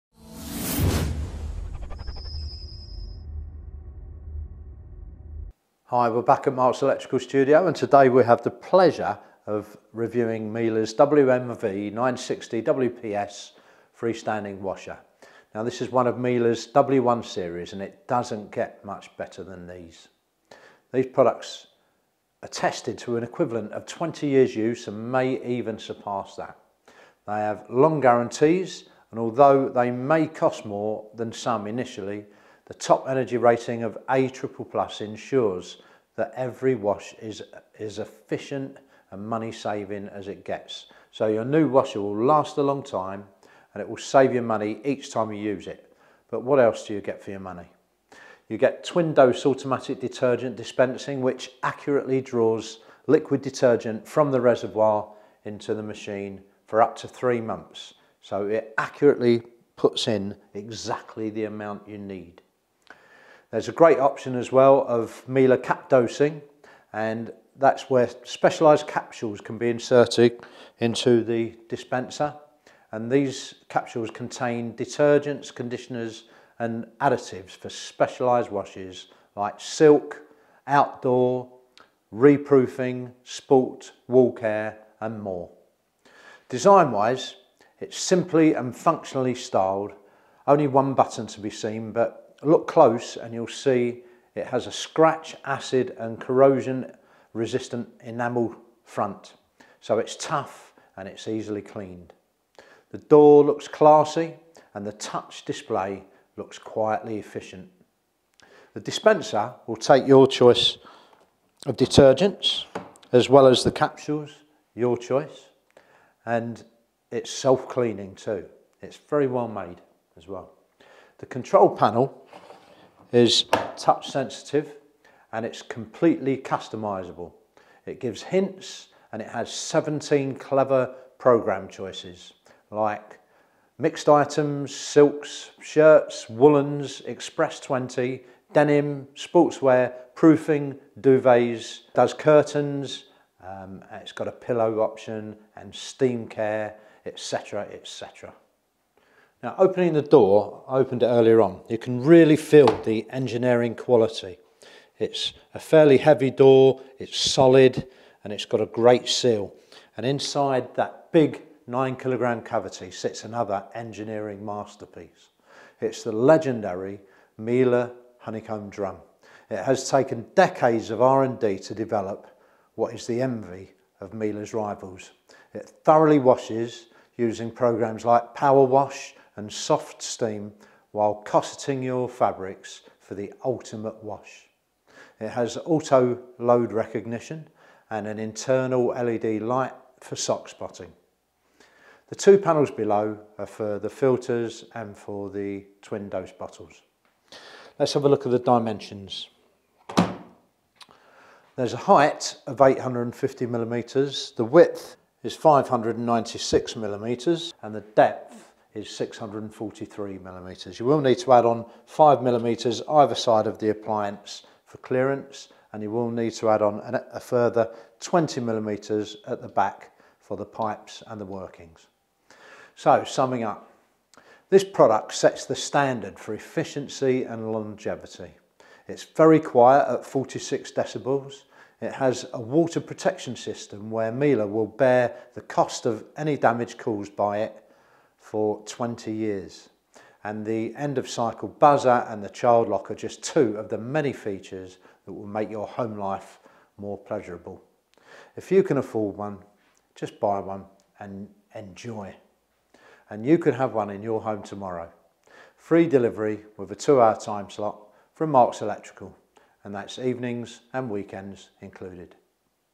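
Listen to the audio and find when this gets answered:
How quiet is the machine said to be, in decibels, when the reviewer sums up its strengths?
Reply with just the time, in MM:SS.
03:50.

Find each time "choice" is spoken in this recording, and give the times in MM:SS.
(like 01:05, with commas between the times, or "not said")
01:50, 01:54, 02:11.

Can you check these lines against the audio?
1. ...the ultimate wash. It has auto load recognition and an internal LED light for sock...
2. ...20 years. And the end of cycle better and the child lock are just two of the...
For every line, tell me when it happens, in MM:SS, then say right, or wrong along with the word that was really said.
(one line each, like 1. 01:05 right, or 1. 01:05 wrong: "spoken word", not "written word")
1. 03:03 right
2. 03:58 wrong: "buzzer", not "better".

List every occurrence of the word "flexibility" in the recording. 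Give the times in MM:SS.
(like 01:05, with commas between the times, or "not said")
not said.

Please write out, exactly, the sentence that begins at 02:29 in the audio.
Now opening the door, I opened it earlier on, you can really feel the engineering quality.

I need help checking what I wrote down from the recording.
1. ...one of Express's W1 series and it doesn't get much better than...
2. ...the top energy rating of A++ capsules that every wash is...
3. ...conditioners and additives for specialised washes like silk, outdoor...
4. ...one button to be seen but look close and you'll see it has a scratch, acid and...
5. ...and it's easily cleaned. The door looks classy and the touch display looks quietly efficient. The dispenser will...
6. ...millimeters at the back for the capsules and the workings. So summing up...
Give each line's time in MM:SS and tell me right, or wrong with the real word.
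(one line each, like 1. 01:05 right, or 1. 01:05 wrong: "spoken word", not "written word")
1. 00:15 wrong: "Miele", not "Express"
2. 00:32 wrong: "ensures", not "capsules"
3. 01:15 right
4. 01:30 right
5. 01:40 right
6. 03:38 wrong: "pipes", not "capsules".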